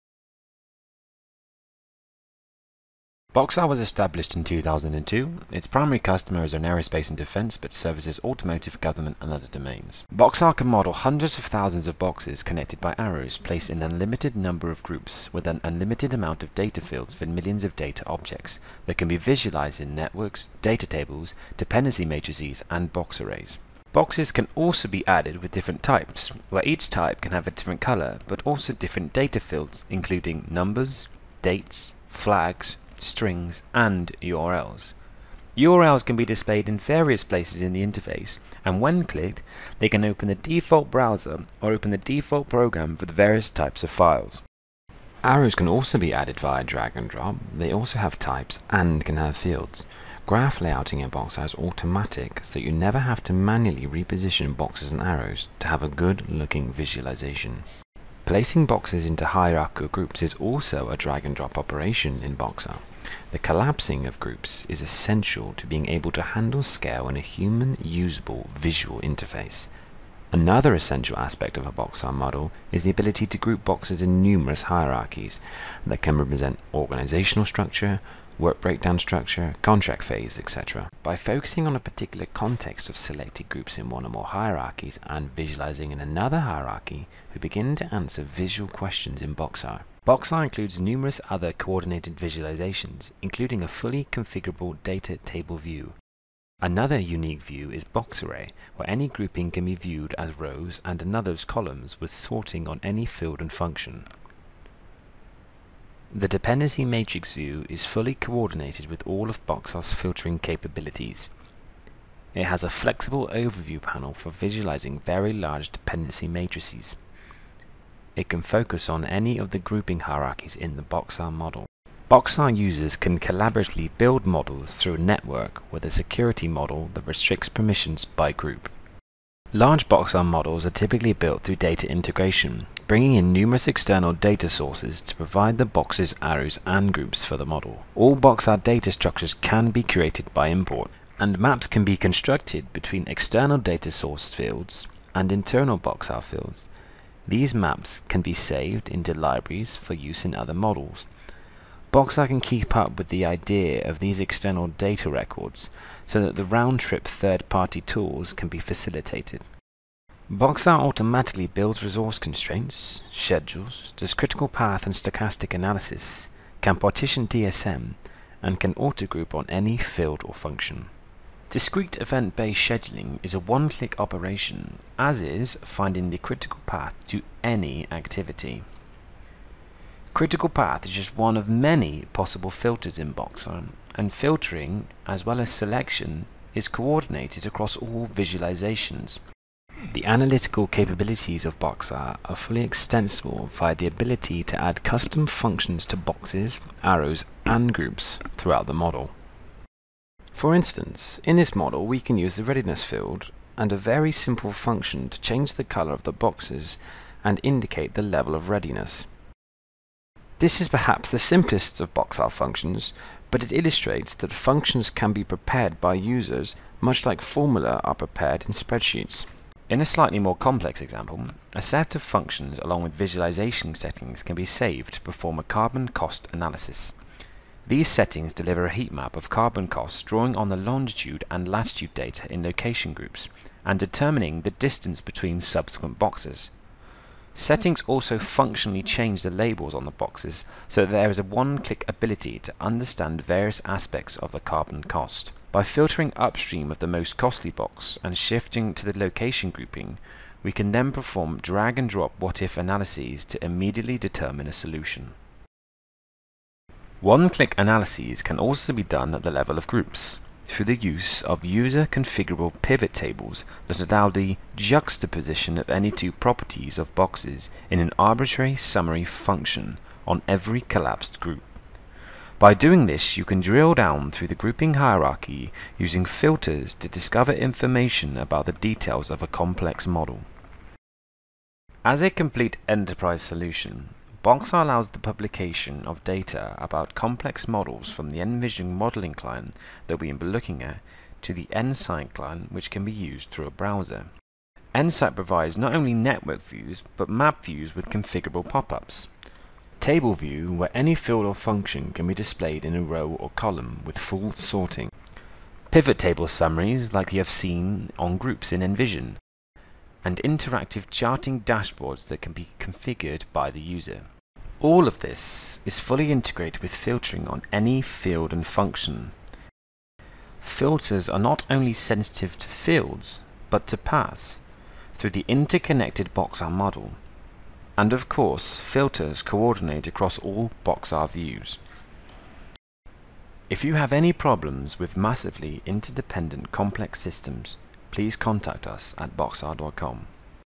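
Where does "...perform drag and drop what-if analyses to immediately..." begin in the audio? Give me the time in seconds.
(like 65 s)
250 s.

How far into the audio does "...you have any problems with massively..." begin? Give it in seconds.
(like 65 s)
333 s.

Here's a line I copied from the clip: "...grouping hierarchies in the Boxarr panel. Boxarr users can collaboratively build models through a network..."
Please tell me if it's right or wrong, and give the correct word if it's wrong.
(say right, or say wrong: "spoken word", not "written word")
wrong: "model", not "panel".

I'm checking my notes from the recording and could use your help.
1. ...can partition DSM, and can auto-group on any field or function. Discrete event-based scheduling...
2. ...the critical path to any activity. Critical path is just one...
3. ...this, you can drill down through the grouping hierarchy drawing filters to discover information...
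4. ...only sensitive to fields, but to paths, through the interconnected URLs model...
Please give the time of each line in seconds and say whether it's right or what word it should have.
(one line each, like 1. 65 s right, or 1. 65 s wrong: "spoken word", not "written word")
1. 166 s right
2. 176 s right
3. 272 s wrong: "using", not "drawing"
4. 321 s wrong: "Boxarr", not "URLs".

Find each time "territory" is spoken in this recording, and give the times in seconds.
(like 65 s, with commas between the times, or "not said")
not said.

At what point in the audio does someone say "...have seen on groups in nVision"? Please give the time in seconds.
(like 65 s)
307 s.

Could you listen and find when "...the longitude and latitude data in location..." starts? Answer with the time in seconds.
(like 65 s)
230 s.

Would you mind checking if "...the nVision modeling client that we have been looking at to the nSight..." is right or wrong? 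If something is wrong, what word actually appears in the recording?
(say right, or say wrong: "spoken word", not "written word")
right.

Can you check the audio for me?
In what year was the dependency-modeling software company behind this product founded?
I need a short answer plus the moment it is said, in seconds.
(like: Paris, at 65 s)
2002, at 4 s.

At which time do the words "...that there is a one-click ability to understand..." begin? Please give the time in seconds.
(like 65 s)
240 s.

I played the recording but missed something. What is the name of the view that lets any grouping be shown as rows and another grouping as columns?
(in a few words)
BoxArray.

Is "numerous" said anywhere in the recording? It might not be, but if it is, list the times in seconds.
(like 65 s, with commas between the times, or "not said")
74 s, 90 s, 133 s.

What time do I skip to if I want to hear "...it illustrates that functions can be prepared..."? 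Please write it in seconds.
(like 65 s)
213 s.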